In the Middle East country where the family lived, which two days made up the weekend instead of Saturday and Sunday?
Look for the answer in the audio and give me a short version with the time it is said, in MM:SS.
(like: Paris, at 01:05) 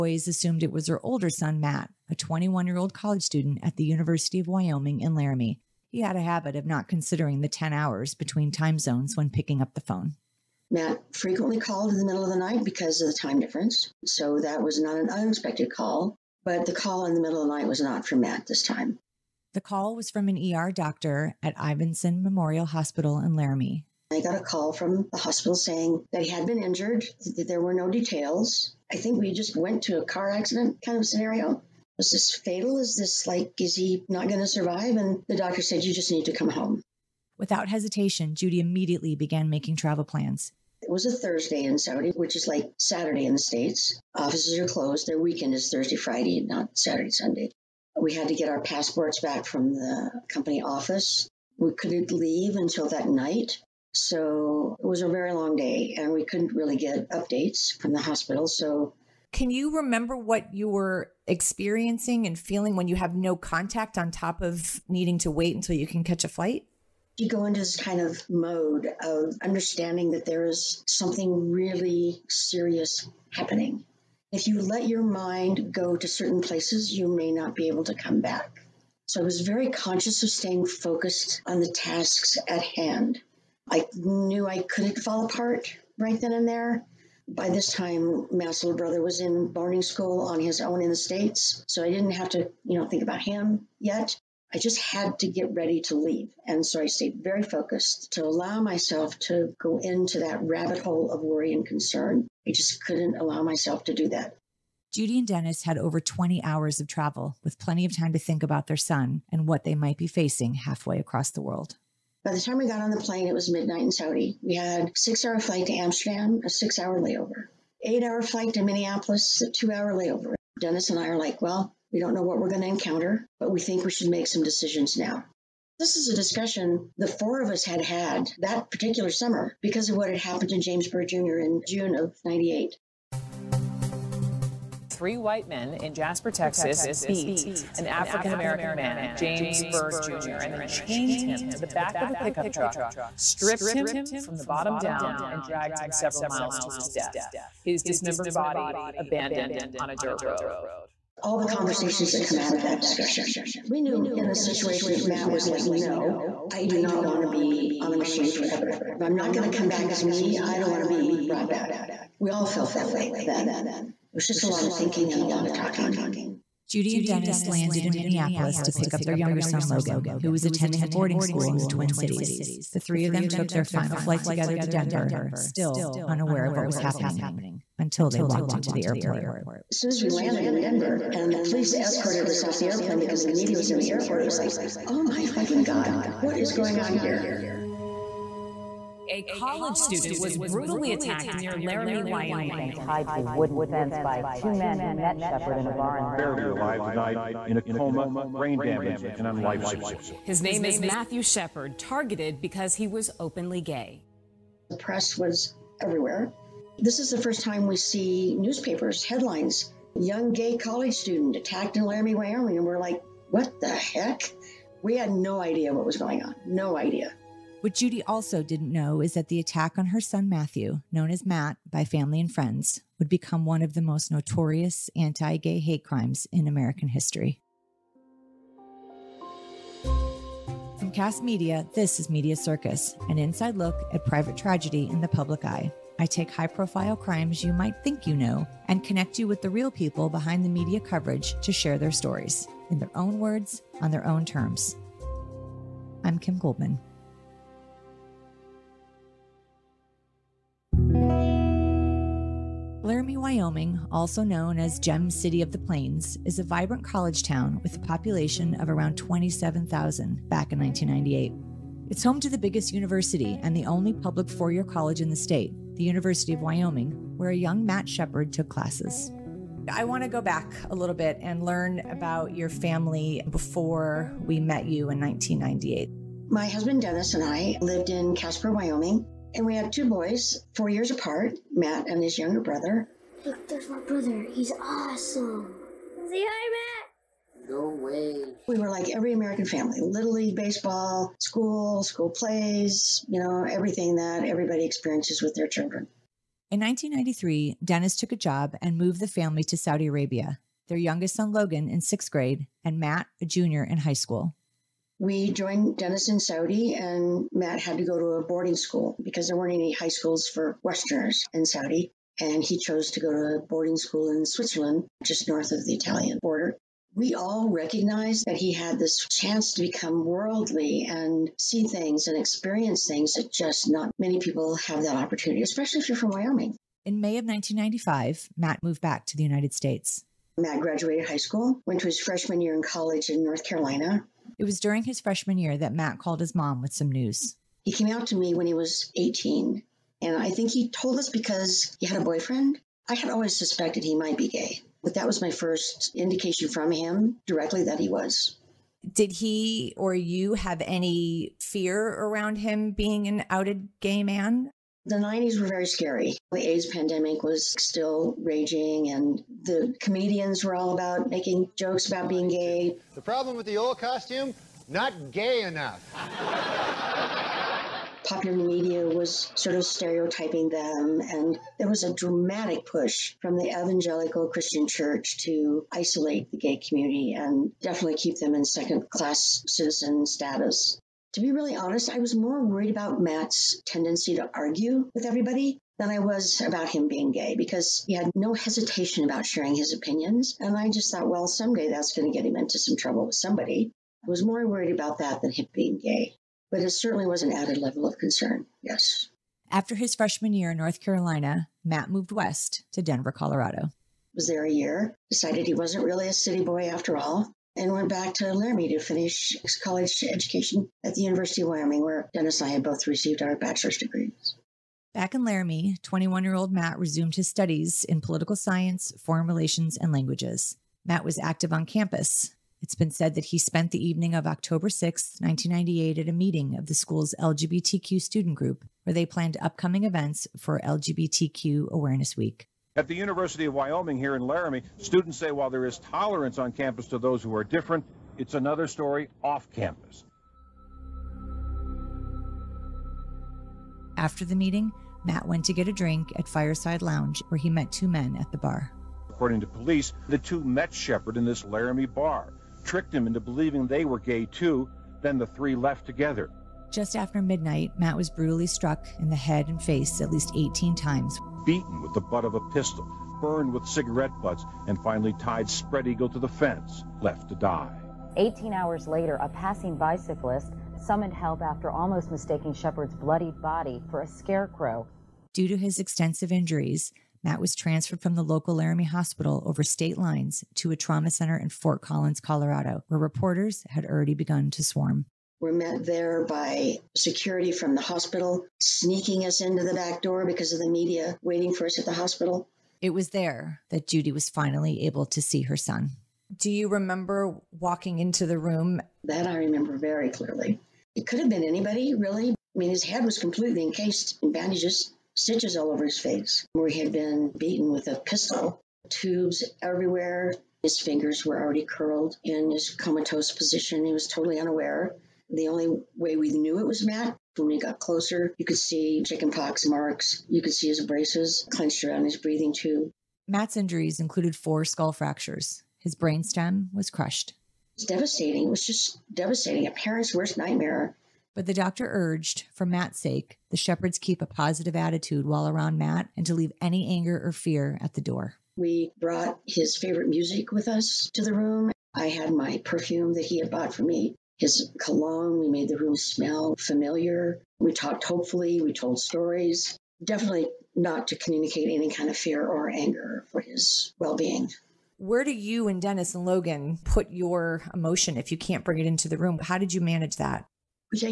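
Thursday, Friday, at 00:45.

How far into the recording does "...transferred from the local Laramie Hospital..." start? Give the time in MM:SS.
07:57.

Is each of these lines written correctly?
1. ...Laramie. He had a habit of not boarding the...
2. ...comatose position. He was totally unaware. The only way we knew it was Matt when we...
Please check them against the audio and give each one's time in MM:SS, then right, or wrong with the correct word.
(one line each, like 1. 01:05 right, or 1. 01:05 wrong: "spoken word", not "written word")
1. 00:05 wrong: "considering", not "boarding"
2. 08:32 right.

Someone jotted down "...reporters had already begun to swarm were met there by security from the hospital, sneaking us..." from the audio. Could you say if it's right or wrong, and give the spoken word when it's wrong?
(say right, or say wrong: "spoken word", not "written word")
right.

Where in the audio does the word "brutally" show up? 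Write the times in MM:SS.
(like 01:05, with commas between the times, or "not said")
03:10, 07:38.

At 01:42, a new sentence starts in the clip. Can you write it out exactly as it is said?
I just couldn't allow myself to do that.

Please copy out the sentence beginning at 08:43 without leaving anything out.
Matt's injuries included four skull fractures.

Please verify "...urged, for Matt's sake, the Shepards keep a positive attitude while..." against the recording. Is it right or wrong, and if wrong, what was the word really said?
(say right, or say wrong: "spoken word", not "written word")
right.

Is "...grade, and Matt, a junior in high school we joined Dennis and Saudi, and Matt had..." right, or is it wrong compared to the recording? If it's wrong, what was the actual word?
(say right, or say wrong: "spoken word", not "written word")
right.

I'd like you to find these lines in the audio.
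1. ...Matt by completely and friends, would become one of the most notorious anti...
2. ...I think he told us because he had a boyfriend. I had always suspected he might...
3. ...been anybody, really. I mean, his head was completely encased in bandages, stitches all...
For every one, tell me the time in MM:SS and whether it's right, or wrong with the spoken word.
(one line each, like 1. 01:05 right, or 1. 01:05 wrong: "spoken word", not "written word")
1. 03:41 wrong: "family", not "completely"
2. 05:40 right
3. 08:21 right.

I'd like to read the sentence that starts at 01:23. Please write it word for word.
I knew I couldn't fall apart right then and there.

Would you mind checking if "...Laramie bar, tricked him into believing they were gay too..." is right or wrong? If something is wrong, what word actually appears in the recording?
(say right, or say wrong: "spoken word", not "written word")
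right.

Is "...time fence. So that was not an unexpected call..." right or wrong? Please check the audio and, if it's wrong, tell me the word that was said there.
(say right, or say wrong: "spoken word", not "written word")
wrong: "difference", not "fence".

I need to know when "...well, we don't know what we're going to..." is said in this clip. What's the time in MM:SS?
02:01.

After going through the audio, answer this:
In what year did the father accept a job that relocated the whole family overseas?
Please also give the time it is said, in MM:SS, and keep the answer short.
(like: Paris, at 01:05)
1993, at 04:56.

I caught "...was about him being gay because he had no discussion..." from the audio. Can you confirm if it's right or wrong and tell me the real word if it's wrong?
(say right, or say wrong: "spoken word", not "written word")
wrong: "hesitation", not "discussion".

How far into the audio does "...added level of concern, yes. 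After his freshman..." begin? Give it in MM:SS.
06:37.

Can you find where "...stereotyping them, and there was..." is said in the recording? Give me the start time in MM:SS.
06:09.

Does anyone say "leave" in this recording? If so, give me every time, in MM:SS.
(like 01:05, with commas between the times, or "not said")
00:52, 01:35, 08:56.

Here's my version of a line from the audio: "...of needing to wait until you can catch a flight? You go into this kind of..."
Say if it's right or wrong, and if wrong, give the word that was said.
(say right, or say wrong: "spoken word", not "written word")
right.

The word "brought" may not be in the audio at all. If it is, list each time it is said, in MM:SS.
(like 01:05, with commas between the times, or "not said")
02:41, 08:58.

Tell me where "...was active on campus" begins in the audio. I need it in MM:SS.
07:01.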